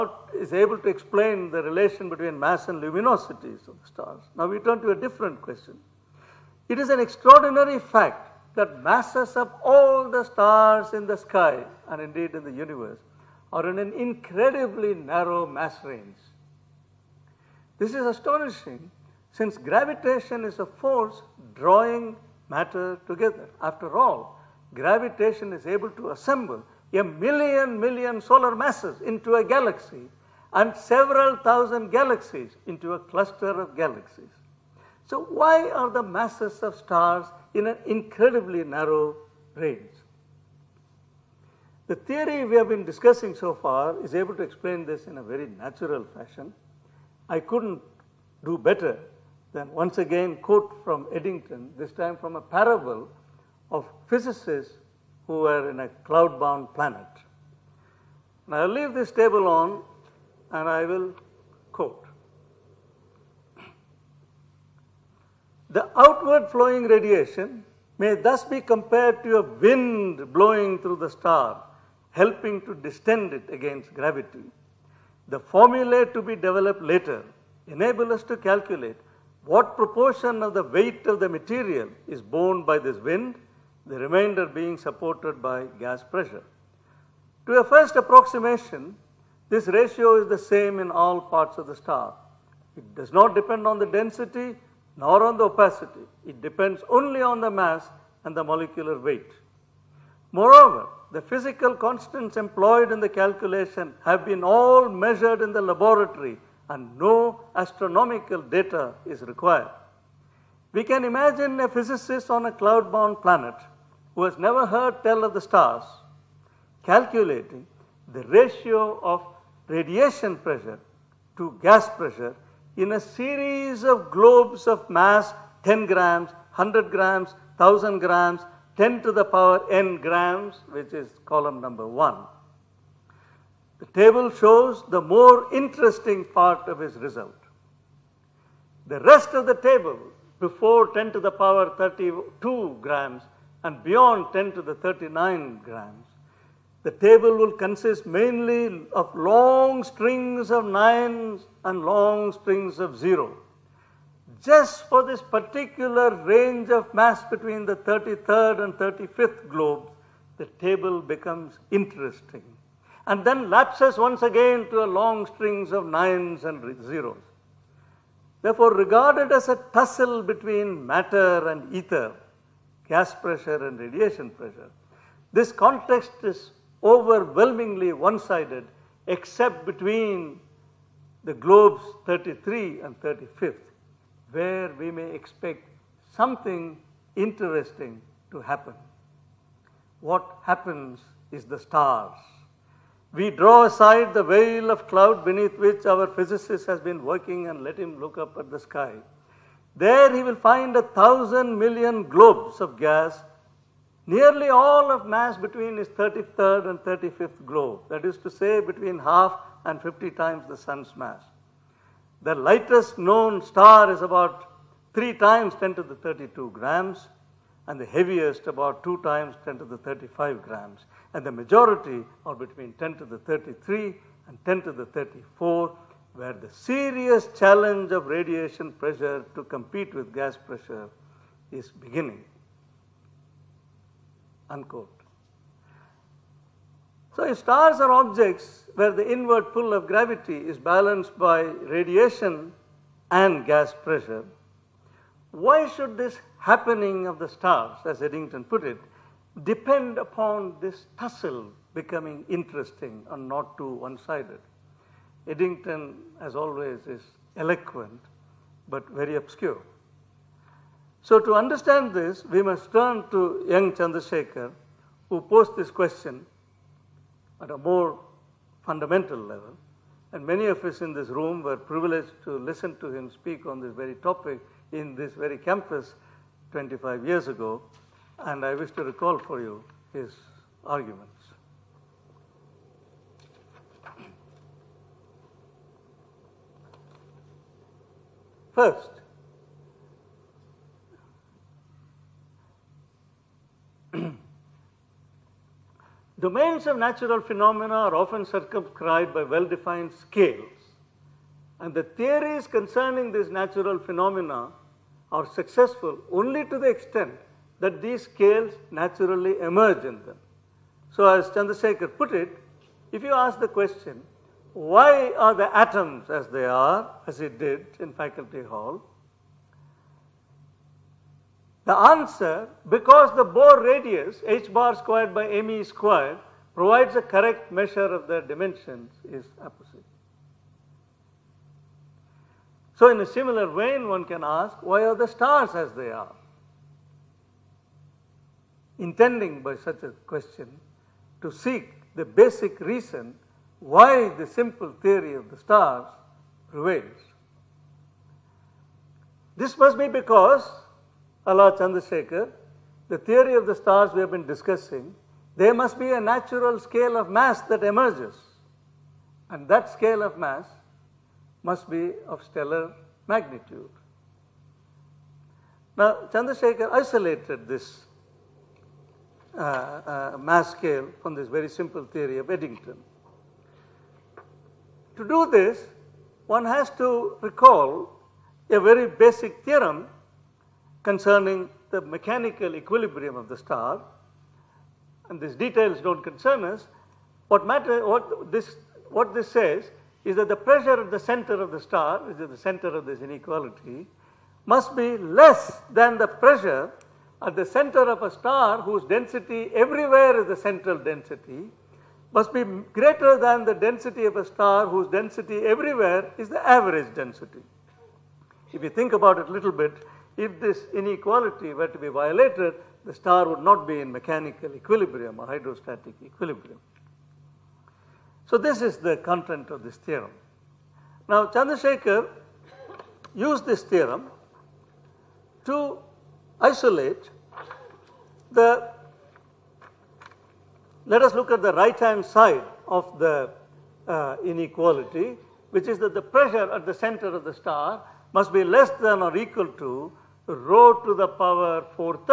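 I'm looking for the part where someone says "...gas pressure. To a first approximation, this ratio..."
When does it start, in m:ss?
1:25.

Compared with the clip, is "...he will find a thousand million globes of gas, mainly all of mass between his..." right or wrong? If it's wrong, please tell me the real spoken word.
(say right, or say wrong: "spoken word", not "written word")
wrong: "nearly", not "mainly".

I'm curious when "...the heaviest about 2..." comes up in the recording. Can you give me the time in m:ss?
3:37.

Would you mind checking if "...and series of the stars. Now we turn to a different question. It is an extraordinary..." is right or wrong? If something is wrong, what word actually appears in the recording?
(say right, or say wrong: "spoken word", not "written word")
wrong: "luminosities", not "series".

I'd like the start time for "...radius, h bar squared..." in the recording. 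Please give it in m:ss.
5:23.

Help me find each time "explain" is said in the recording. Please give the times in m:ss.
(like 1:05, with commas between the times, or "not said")
0:00, 0:44.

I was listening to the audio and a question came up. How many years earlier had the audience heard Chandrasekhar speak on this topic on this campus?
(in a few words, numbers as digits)
25.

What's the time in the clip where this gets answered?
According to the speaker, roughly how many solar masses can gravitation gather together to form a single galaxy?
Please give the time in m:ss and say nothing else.
0:26.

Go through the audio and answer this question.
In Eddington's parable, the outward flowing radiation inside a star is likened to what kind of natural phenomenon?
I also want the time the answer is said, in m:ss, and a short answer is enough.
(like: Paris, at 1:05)
a wind, at 1:09.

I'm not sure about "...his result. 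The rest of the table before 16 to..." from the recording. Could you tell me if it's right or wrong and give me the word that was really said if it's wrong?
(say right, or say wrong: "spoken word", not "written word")
wrong: "10", not "16".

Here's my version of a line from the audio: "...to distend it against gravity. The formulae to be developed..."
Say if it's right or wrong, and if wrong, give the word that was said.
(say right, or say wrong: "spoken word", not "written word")
right.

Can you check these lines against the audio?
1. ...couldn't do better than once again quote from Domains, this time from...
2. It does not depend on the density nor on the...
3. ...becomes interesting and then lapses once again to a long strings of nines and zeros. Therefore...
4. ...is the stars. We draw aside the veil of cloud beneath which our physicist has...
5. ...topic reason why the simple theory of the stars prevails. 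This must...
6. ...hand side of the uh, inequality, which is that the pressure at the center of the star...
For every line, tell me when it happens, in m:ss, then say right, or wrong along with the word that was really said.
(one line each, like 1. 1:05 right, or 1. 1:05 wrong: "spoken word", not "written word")
1. 0:47 wrong: "Eddington", not "Domains"
2. 1:32 right
3. 2:41 right
4. 3:11 right
5. 5:42 wrong: "basic", not "topic"
6. 7:11 right.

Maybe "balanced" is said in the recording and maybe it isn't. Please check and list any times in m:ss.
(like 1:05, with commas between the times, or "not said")
4:00.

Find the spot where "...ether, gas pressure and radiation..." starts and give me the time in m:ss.
2:51.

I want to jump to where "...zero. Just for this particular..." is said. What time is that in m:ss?
2:32.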